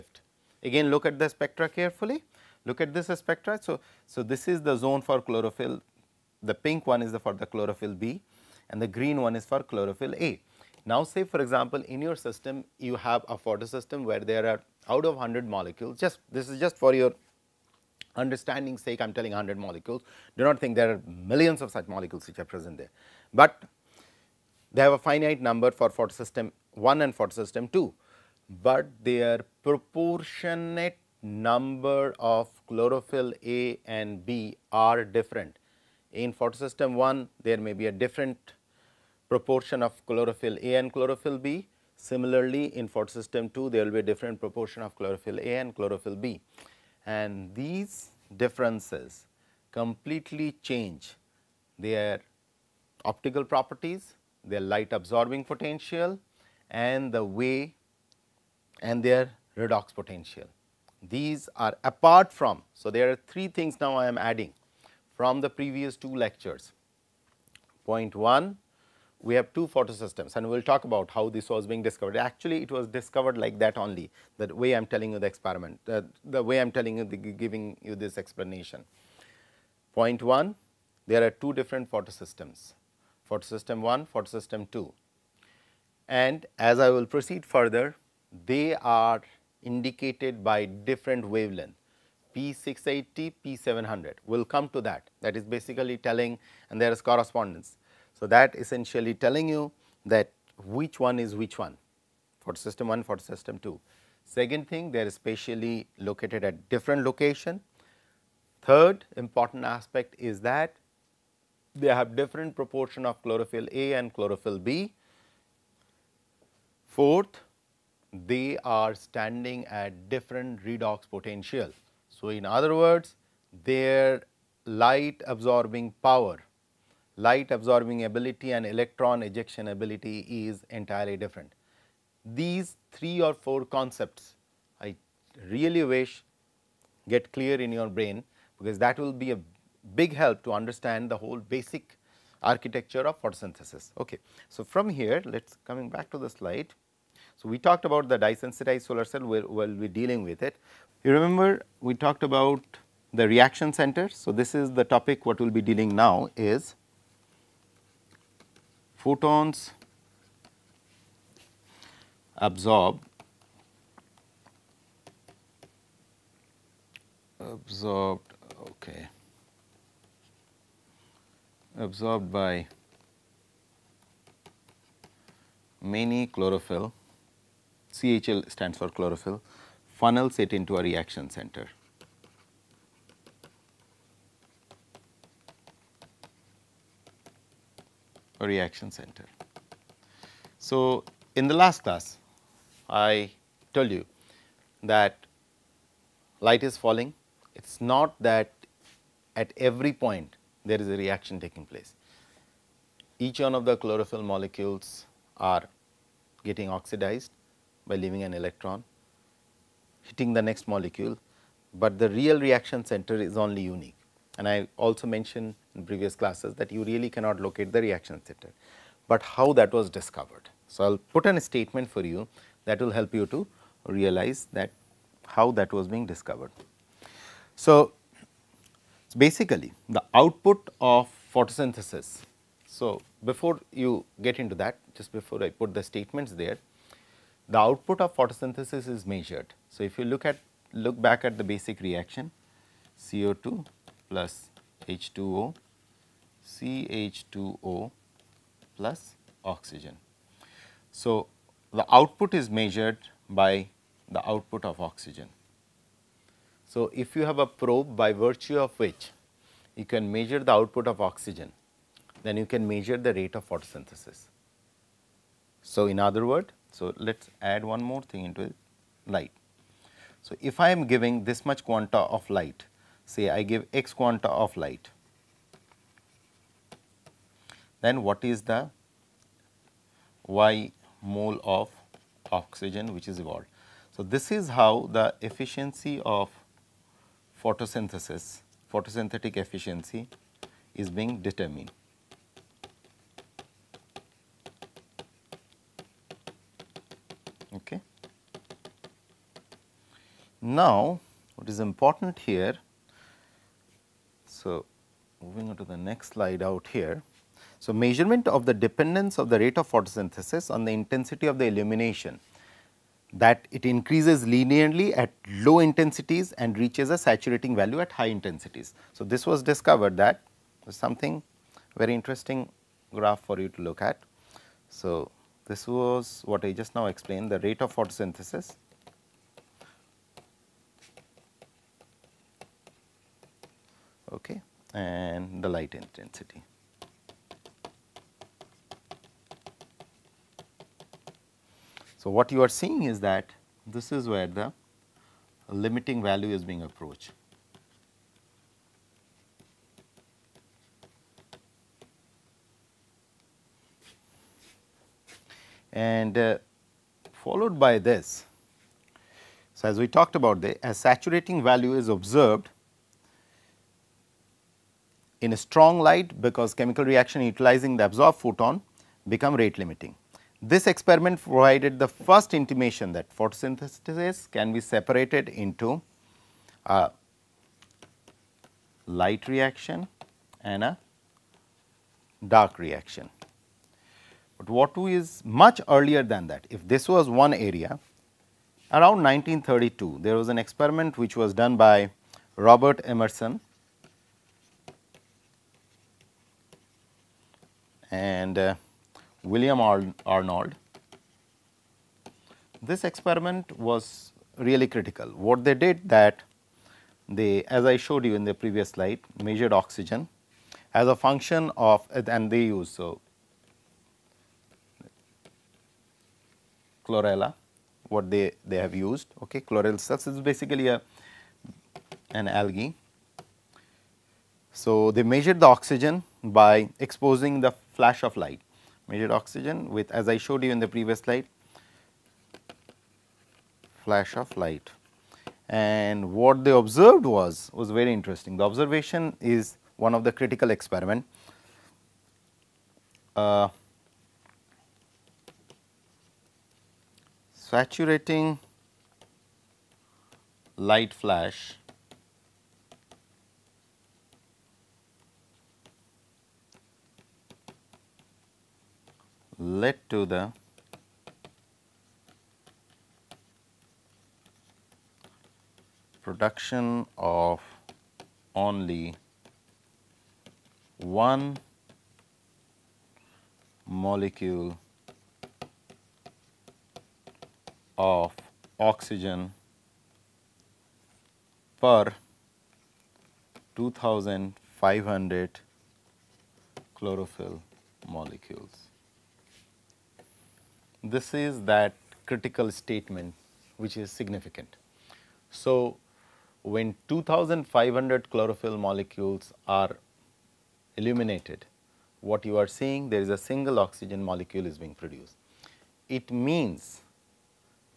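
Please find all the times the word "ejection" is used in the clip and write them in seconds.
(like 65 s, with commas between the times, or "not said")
129 s.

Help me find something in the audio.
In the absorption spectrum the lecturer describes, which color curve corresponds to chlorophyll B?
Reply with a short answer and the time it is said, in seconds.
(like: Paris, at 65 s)
Pink, at 6 s.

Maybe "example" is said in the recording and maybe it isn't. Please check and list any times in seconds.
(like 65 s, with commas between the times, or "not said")
11 s.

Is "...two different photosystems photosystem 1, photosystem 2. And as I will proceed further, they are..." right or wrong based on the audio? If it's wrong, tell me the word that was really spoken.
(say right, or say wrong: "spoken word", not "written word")
right.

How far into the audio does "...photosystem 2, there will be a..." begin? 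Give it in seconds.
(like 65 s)
42 s.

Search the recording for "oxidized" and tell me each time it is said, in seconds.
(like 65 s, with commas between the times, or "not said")
206 s.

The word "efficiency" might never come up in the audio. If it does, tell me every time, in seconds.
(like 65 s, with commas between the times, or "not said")
285 s, 289 s.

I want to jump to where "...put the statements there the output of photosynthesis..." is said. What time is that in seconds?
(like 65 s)
235 s.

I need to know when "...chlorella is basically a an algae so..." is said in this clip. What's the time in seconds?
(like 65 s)
419 s.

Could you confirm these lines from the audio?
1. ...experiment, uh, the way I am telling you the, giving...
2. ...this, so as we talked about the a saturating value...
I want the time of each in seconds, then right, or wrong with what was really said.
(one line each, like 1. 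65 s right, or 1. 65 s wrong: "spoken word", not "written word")
1. 75 s right
2. 357 s right.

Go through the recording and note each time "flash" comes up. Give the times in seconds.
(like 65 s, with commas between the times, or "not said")
427 s, 433 s, 450 s.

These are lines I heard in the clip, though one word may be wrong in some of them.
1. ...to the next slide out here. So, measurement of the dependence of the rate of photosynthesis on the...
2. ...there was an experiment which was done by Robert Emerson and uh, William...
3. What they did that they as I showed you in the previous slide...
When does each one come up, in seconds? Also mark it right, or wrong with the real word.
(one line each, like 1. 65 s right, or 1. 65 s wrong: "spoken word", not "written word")
1. 305 s right
2. 390 s right
3. 405 s right.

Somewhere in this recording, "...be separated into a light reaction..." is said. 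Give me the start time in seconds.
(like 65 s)
374 s.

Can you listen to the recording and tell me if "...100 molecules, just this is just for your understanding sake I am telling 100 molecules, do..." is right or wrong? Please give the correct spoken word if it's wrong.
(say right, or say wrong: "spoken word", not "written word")
right.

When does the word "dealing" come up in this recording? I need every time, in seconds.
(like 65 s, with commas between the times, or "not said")
149 s, 155 s.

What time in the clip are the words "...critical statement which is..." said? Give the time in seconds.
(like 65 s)
492 s.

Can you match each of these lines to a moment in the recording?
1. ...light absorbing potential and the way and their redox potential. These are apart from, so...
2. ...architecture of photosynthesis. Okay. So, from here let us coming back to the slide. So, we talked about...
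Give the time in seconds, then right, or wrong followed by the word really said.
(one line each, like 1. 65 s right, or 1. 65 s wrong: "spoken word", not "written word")
1. 54 s right
2. 142 s right.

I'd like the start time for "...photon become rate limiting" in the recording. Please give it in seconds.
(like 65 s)
368 s.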